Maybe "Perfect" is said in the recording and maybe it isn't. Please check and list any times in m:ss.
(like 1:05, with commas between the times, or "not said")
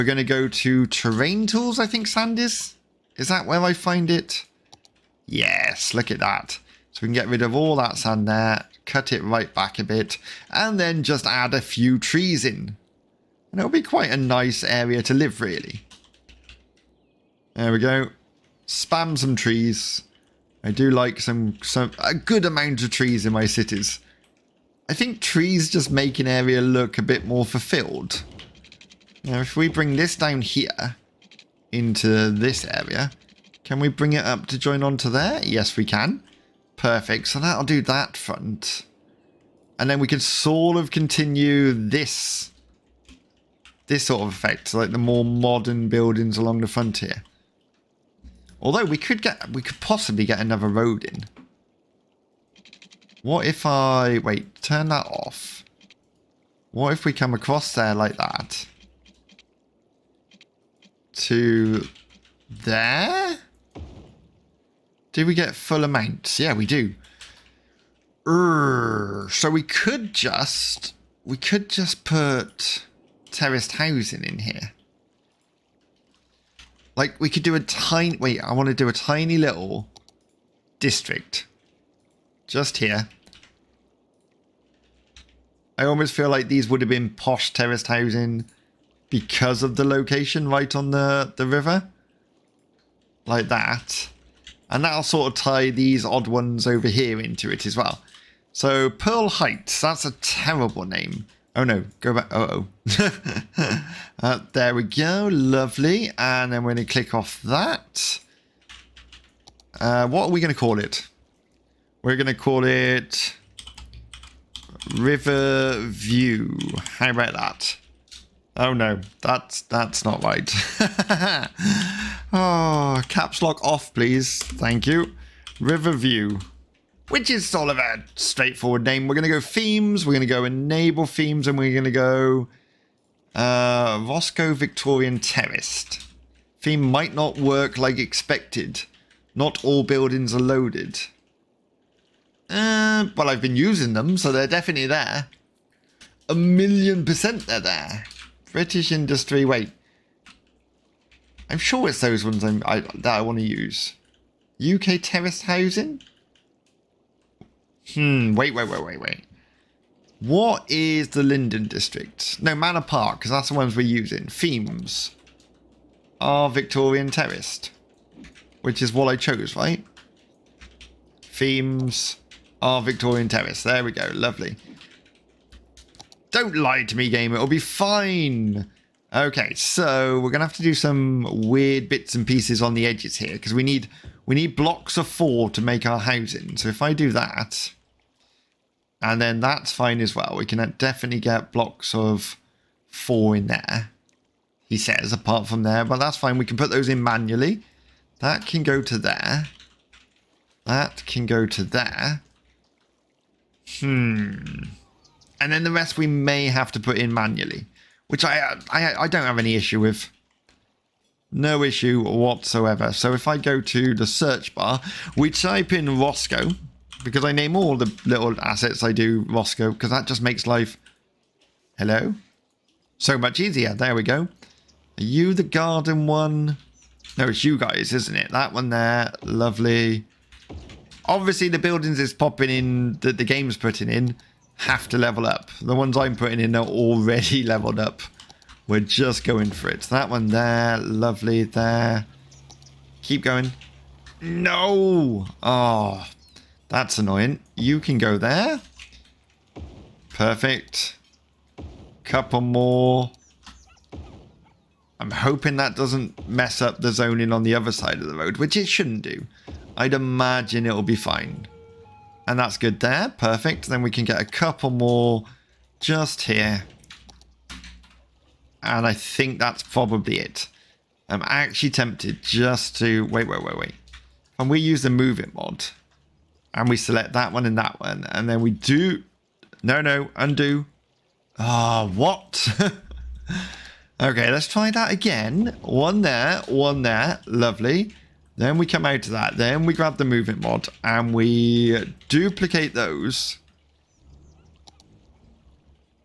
0:36, 4:10, 4:23.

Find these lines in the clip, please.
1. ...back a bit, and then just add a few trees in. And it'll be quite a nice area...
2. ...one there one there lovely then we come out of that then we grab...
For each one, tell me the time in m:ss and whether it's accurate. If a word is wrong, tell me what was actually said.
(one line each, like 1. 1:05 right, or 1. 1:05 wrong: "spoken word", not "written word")
1. 0:09 right
2. 4:45 right.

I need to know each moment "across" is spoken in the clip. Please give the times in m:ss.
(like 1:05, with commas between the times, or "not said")
0:57.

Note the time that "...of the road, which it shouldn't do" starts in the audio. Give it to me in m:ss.
4:17.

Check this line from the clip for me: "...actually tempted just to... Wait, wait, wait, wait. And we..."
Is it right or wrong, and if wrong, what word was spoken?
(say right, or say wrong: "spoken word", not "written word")
right.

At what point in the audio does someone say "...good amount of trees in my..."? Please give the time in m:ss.
0:22.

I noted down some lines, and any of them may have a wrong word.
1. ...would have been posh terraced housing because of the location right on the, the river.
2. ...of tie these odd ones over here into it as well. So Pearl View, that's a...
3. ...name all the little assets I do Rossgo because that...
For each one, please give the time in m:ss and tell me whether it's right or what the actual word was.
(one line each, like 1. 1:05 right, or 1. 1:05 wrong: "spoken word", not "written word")
1. 1:26 right
2. 1:35 wrong: "Heights", not "View"
3. 3:37 right.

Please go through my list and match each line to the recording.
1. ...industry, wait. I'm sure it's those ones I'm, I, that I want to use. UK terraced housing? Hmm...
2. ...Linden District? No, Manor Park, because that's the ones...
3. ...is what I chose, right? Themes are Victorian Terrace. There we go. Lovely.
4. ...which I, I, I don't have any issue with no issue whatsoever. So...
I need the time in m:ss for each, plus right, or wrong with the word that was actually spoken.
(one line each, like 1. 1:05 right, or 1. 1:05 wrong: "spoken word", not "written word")
1. 2:28 right
2. 2:41 right
3. 2:48 right
4. 3:28 right.